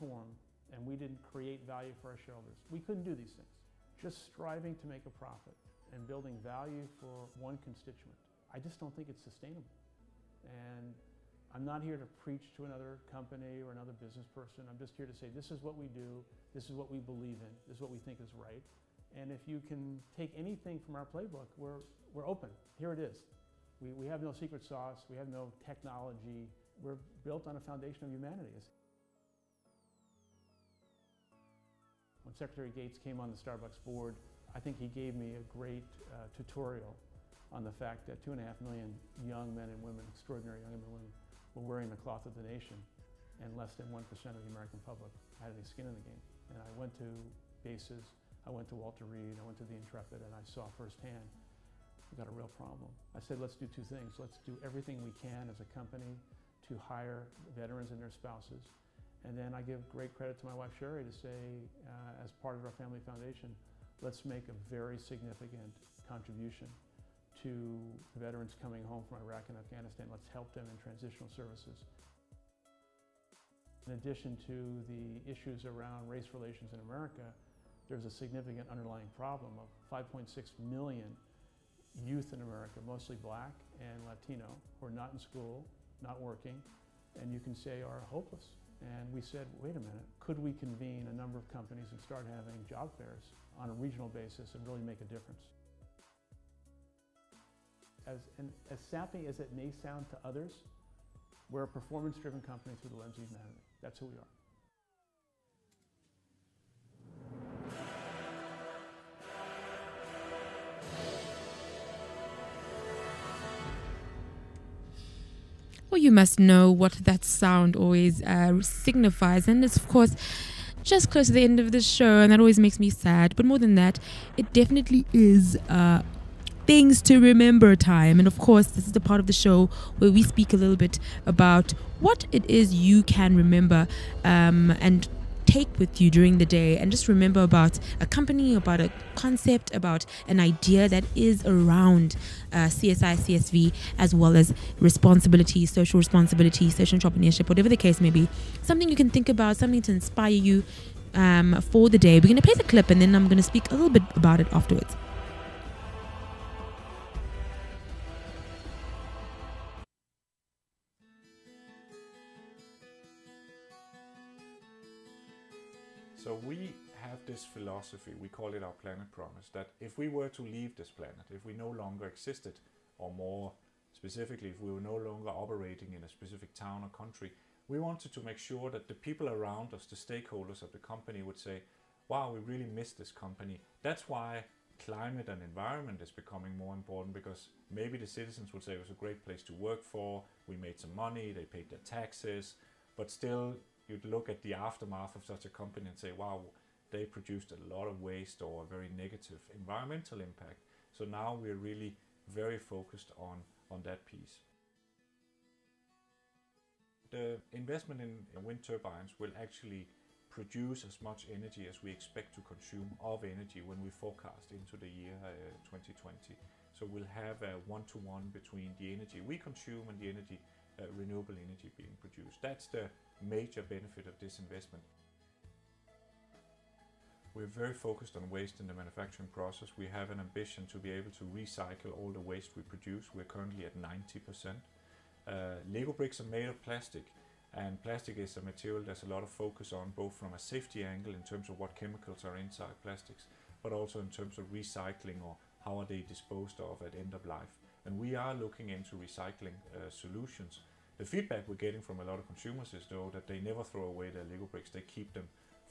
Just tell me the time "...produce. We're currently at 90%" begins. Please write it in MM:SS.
03:52.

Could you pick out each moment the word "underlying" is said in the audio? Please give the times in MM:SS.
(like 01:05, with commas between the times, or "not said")
01:18.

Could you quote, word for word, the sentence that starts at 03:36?
So we'll have a one-to-one -one between the energy we consume and the energy uh, renewable energy being produced.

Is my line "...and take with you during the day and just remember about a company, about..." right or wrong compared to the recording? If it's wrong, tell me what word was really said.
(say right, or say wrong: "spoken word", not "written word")
right.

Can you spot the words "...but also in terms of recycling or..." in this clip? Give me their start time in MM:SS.
04:03.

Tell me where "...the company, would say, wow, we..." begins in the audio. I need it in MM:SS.
03:00.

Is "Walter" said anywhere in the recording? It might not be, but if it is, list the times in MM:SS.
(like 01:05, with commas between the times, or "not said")
00:48.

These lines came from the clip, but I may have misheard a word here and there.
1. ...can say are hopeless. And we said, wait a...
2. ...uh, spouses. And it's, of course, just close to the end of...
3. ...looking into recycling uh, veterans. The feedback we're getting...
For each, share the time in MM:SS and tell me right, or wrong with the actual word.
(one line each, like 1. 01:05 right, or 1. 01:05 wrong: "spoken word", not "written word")
1. 01:27 right
2. 01:58 wrong: "signifies", not "spouses"
3. 04:08 wrong: "solutions", not "veterans".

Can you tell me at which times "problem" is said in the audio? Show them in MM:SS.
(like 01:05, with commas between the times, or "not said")
00:52, 01:19.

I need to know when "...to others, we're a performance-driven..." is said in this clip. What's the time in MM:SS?
01:40.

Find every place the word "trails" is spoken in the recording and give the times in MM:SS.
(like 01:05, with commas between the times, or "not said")
not said.